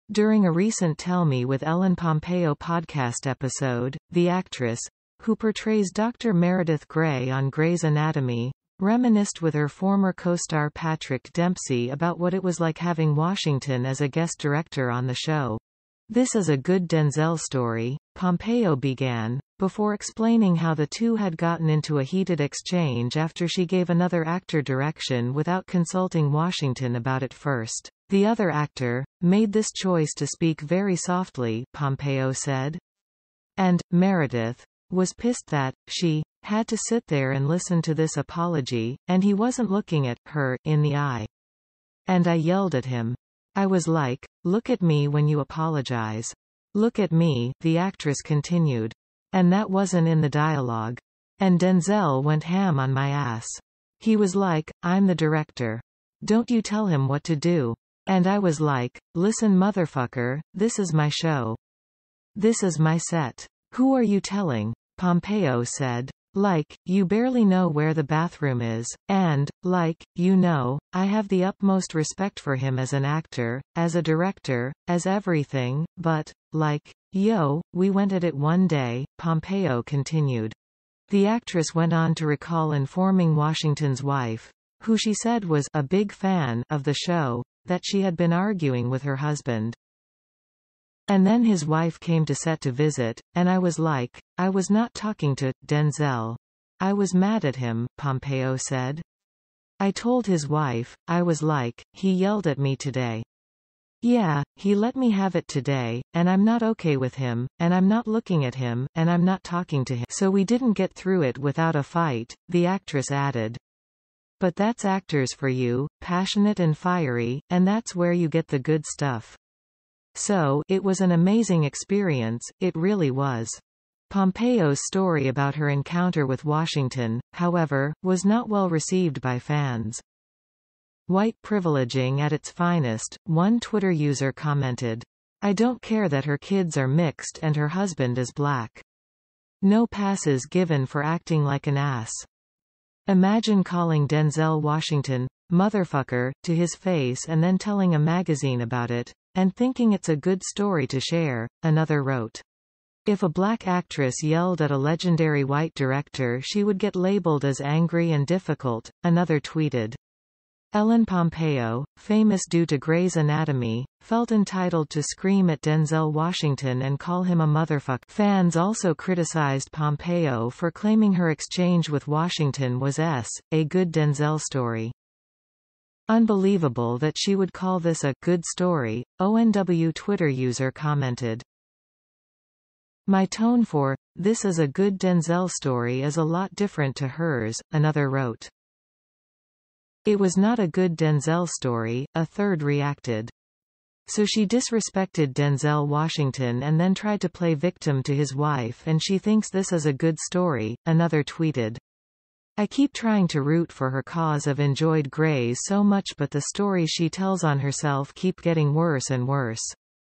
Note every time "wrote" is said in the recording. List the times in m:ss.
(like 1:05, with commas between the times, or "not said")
2:32, 3:08.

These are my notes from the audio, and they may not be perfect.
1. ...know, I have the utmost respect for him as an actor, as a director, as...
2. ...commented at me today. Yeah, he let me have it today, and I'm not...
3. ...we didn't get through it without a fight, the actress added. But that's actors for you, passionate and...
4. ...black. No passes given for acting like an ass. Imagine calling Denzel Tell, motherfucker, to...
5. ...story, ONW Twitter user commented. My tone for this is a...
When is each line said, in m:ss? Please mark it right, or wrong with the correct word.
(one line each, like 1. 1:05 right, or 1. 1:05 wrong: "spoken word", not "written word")
1. 1:10 right
2. 1:42 wrong: "yelled", not "commented"
3. 1:50 right
4. 2:18 wrong: "Washington", not "Tell"
5. 2:58 right.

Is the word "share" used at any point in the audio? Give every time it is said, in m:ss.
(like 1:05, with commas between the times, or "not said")
2:30.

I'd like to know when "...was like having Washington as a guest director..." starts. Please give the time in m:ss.
0:12.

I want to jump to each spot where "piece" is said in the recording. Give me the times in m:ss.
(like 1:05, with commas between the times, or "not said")
not said.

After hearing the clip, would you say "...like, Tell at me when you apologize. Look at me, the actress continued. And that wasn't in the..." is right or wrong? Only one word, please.
wrong.